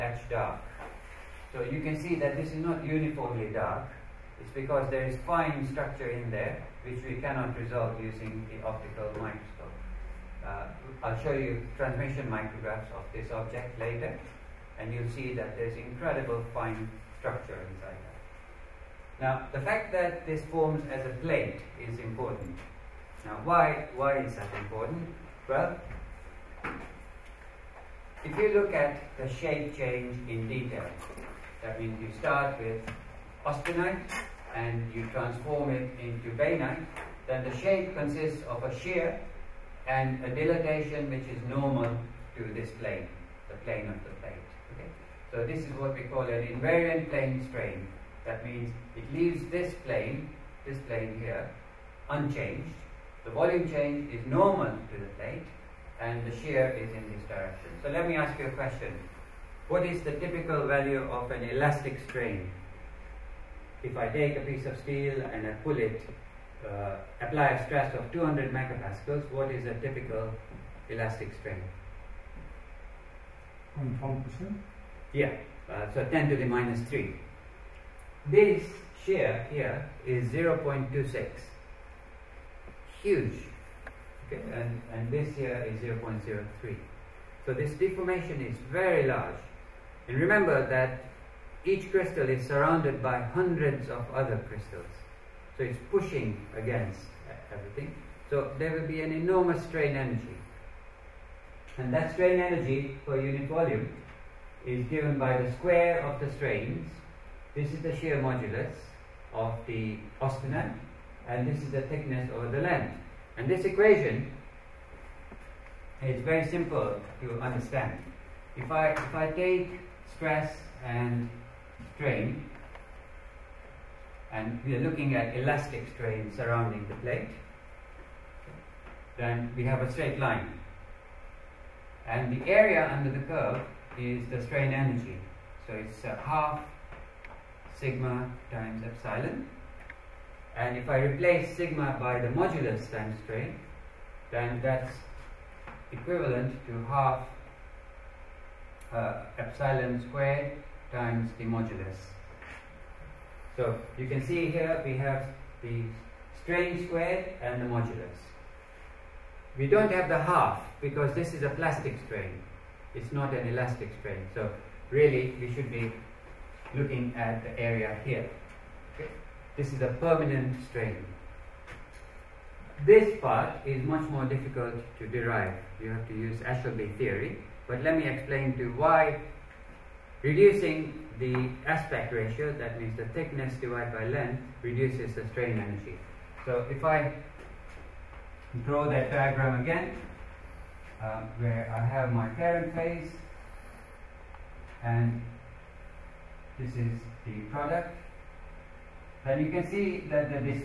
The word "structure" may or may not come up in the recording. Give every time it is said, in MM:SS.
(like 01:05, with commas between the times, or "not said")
00:05, 00:17.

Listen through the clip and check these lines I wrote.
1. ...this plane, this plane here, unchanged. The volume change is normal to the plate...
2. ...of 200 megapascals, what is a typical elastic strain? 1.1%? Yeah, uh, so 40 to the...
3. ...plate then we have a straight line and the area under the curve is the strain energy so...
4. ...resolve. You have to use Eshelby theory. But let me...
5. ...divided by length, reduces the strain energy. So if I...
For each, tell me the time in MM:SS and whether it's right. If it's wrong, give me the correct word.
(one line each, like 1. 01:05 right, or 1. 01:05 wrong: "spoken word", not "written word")
1. 00:49 right
2. 01:07 wrong: "10", not "40"
3. 02:06 right
4. 02:55 wrong: "derive", not "resolve"
5. 03:03 right.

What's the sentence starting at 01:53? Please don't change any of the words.
And this equation is very simple to understand.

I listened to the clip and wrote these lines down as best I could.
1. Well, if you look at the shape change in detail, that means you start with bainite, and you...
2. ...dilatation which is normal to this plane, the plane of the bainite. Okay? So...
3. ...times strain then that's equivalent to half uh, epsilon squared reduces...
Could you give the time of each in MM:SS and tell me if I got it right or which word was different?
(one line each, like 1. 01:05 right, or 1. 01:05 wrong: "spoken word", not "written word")
1. 00:25 wrong: "austenite", not "bainite"
2. 00:40 wrong: "plate", not "bainite"
3. 02:22 wrong: "times", not "reduces".